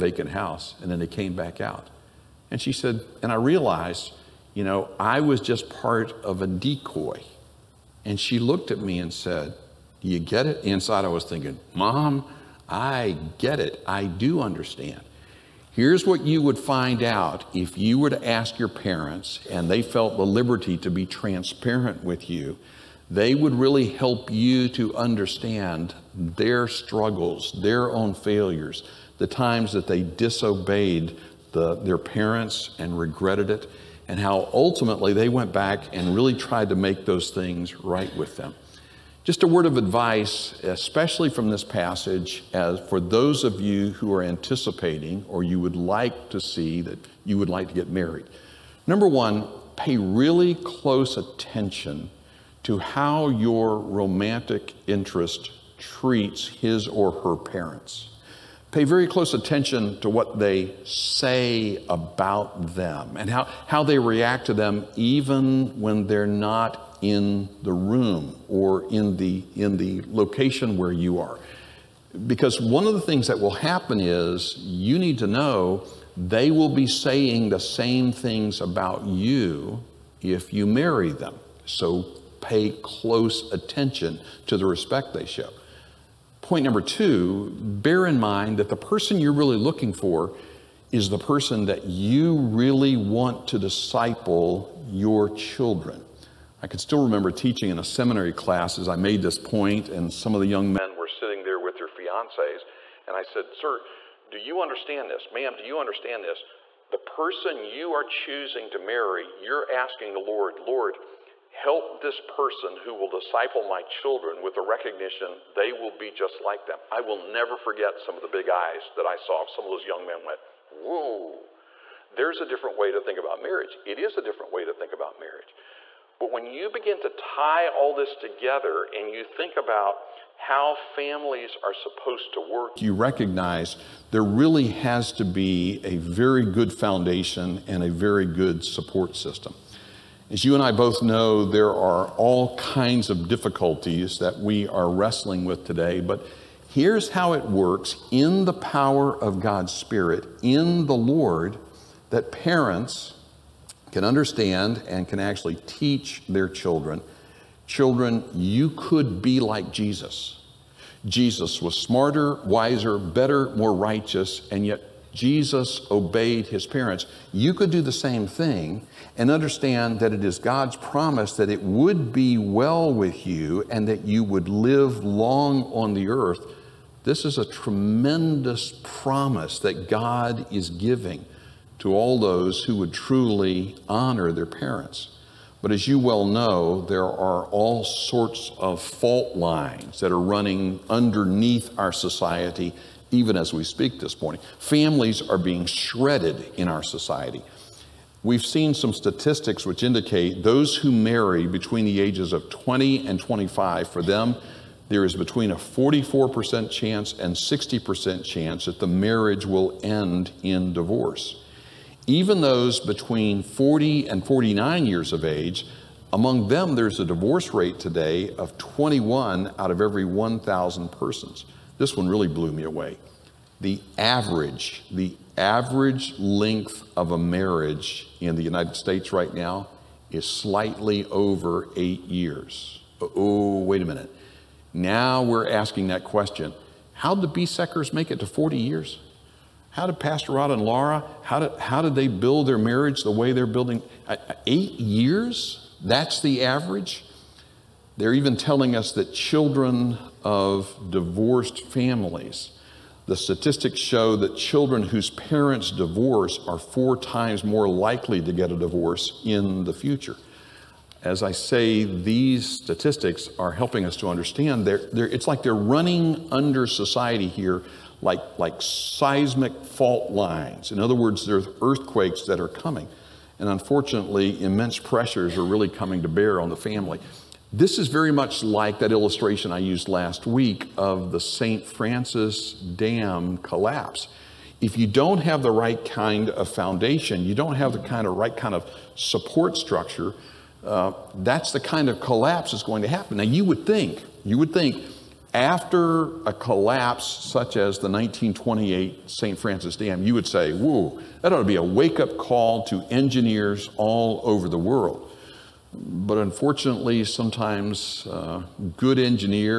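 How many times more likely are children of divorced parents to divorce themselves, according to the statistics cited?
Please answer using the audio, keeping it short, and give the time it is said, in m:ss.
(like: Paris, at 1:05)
4 times, at 4:16.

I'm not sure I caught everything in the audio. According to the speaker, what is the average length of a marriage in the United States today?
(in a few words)
slightly over 8 years.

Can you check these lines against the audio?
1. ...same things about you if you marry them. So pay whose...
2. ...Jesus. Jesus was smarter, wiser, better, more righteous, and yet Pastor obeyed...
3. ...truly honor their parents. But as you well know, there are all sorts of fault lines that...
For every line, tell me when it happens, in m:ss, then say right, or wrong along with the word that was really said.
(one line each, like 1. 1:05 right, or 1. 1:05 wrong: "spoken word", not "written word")
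1. 1:17 wrong: "close", not "whose"
2. 2:39 wrong: "Jesus", not "Pastor"
3. 3:02 right.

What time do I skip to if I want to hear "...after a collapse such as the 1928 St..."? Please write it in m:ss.
4:55.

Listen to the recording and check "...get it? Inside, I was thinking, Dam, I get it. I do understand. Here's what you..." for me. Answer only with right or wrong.
wrong.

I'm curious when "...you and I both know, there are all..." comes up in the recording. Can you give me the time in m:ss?
2:20.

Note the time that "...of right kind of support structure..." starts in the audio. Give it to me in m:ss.
4:48.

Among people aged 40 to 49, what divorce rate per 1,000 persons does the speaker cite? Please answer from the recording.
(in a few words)
21.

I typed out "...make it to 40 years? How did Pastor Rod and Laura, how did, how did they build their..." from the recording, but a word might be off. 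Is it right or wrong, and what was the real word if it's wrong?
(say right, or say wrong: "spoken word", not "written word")
right.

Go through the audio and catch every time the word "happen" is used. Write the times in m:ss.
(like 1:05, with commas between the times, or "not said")
1:13, 4:52.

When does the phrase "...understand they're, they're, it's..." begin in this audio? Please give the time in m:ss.
4:24.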